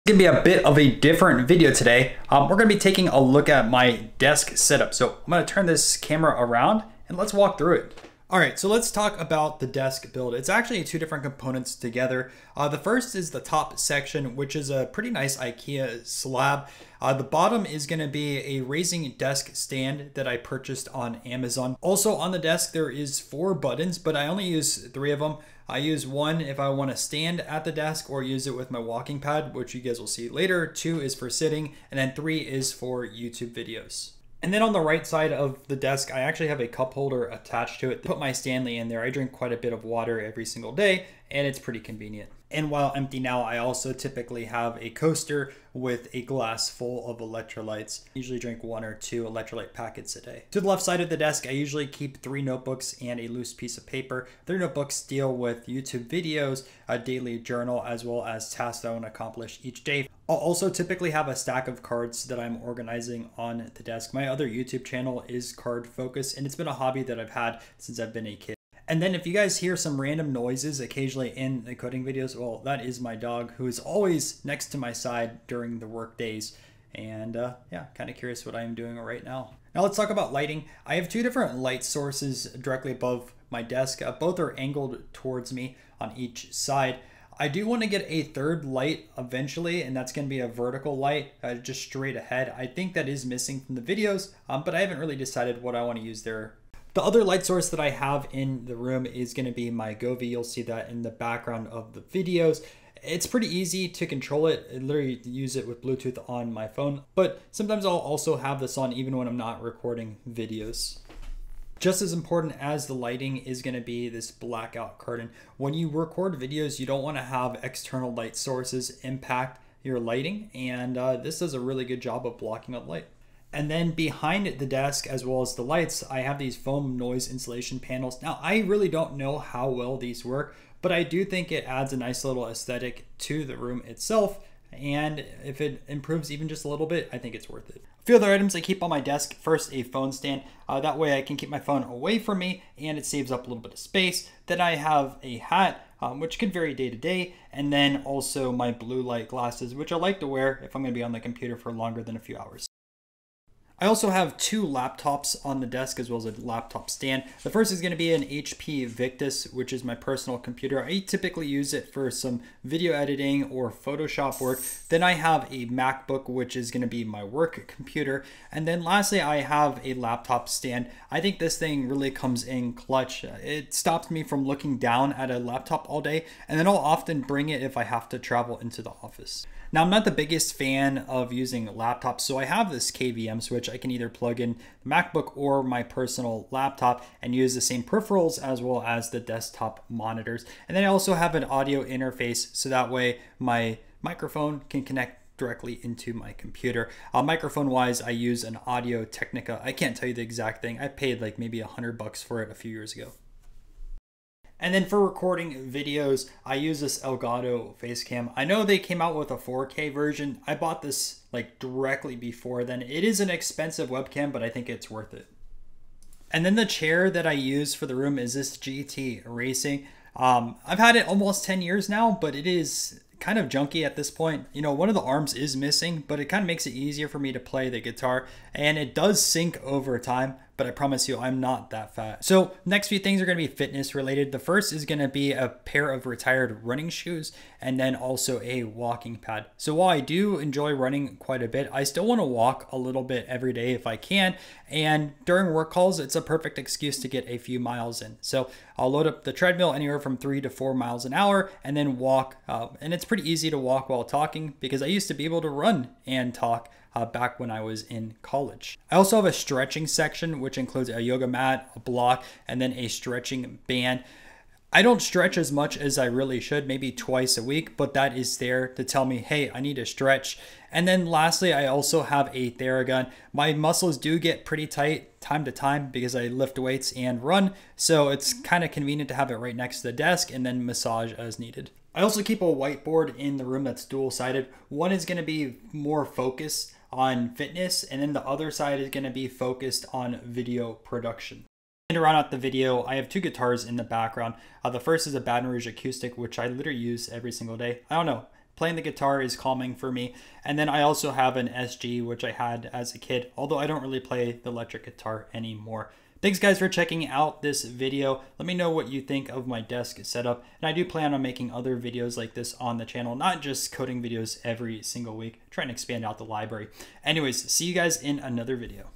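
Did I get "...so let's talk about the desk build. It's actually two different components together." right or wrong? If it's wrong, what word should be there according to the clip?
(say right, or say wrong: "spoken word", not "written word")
right.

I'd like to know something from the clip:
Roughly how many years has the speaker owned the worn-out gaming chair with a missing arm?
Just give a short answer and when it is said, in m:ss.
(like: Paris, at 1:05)
10, at 3:41.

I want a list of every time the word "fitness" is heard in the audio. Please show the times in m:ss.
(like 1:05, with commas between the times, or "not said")
3:53, 4:47.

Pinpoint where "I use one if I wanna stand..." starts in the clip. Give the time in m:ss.
0:25.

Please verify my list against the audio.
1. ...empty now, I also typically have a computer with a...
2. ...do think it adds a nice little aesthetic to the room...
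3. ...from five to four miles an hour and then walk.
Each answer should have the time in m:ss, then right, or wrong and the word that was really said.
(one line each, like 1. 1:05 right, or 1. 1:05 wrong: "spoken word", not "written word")
1. 0:42 wrong: "coaster", not "computer"
2. 2:11 right
3. 4:09 wrong: "three", not "five".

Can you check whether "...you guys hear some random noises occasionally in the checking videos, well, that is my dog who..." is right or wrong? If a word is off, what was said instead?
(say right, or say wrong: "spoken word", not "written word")
wrong: "coding", not "checking".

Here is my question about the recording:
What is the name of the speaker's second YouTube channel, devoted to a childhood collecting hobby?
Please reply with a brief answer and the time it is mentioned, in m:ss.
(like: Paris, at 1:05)
Card Focus, at 1:05.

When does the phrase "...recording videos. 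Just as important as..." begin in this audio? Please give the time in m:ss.
1:49.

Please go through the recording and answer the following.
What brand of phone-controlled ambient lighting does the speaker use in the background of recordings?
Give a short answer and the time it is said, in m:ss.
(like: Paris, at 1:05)
Govee, at 1:39.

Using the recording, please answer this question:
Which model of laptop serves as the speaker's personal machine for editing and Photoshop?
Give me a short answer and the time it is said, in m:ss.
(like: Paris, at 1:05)
HP Victus, at 2:38.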